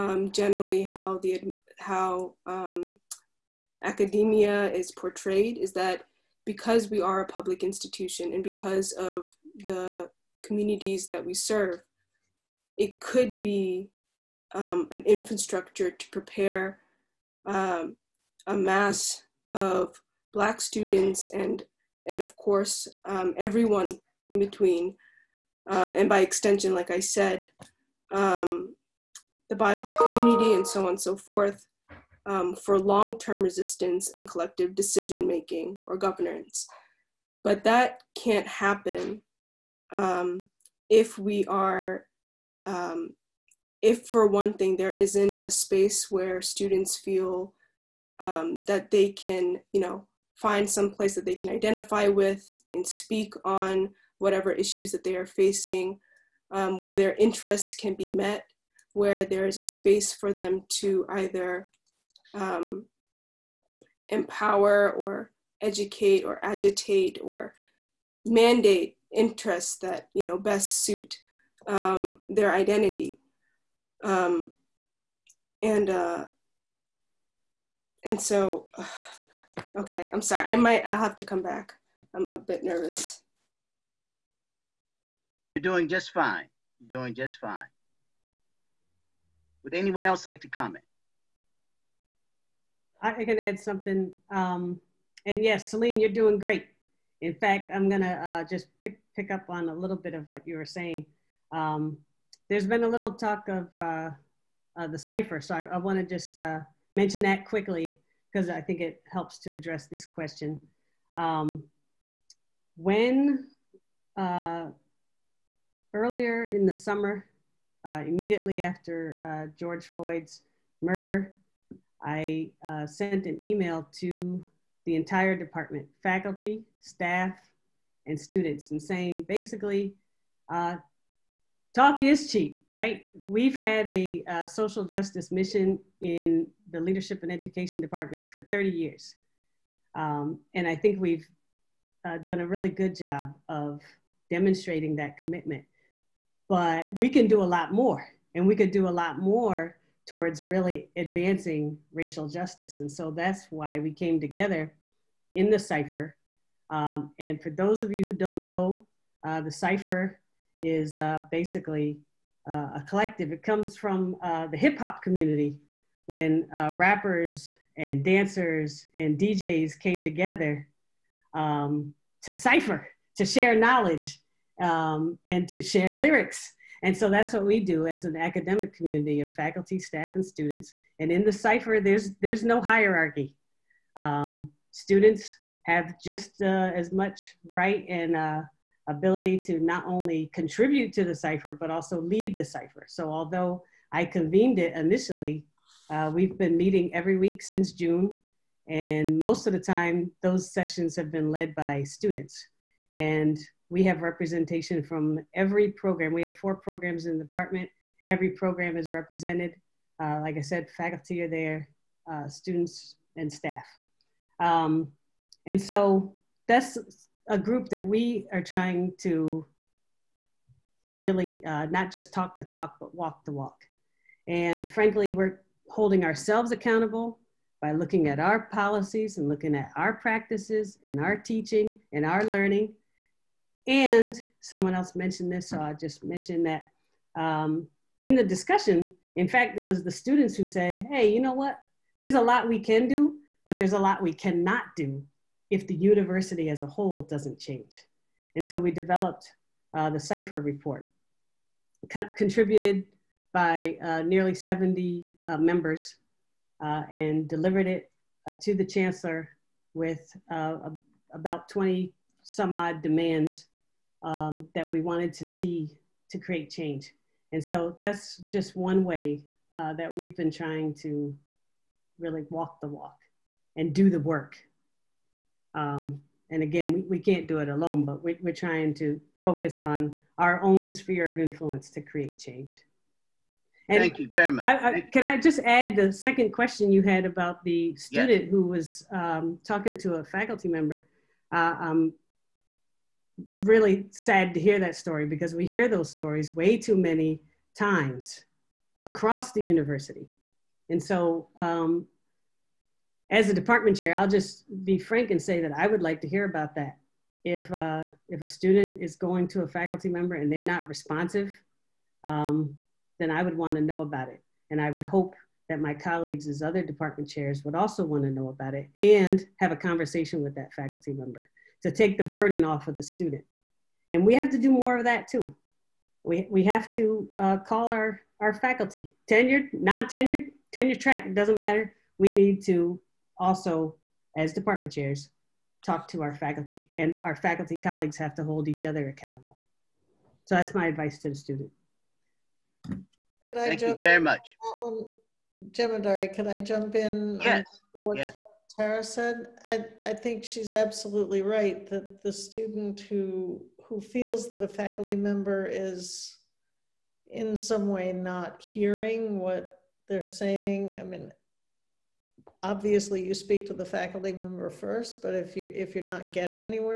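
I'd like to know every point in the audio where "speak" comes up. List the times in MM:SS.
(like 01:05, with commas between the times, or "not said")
00:52, 06:03.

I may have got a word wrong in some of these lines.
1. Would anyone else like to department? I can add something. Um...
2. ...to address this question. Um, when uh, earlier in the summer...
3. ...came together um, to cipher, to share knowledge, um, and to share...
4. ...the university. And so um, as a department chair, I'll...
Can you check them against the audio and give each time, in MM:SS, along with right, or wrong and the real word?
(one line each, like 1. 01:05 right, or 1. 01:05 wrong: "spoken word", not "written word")
1. 01:29 wrong: "comment", not "department"
2. 01:49 right
3. 02:49 right
4. 04:59 right.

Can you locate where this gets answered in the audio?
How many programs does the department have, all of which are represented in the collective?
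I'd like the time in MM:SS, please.
03:26.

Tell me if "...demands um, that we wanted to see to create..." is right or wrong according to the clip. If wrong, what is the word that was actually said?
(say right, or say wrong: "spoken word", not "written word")
right.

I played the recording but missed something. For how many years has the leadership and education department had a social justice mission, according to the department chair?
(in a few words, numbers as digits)
30 years.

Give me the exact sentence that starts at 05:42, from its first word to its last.
Could I Thank jump you very in?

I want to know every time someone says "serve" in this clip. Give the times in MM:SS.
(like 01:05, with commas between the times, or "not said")
00:11.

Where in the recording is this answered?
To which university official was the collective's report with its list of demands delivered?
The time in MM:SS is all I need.
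04:18.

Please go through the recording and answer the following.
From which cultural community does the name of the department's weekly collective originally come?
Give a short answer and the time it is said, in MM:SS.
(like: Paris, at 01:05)
hip hop, at 02:44.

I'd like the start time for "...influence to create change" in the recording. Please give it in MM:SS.
04:41.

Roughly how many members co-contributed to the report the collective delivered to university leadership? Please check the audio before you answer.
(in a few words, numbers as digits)
70.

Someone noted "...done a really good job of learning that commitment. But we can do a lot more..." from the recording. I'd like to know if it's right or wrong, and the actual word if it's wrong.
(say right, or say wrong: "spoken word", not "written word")
wrong: "demonstrating", not "learning".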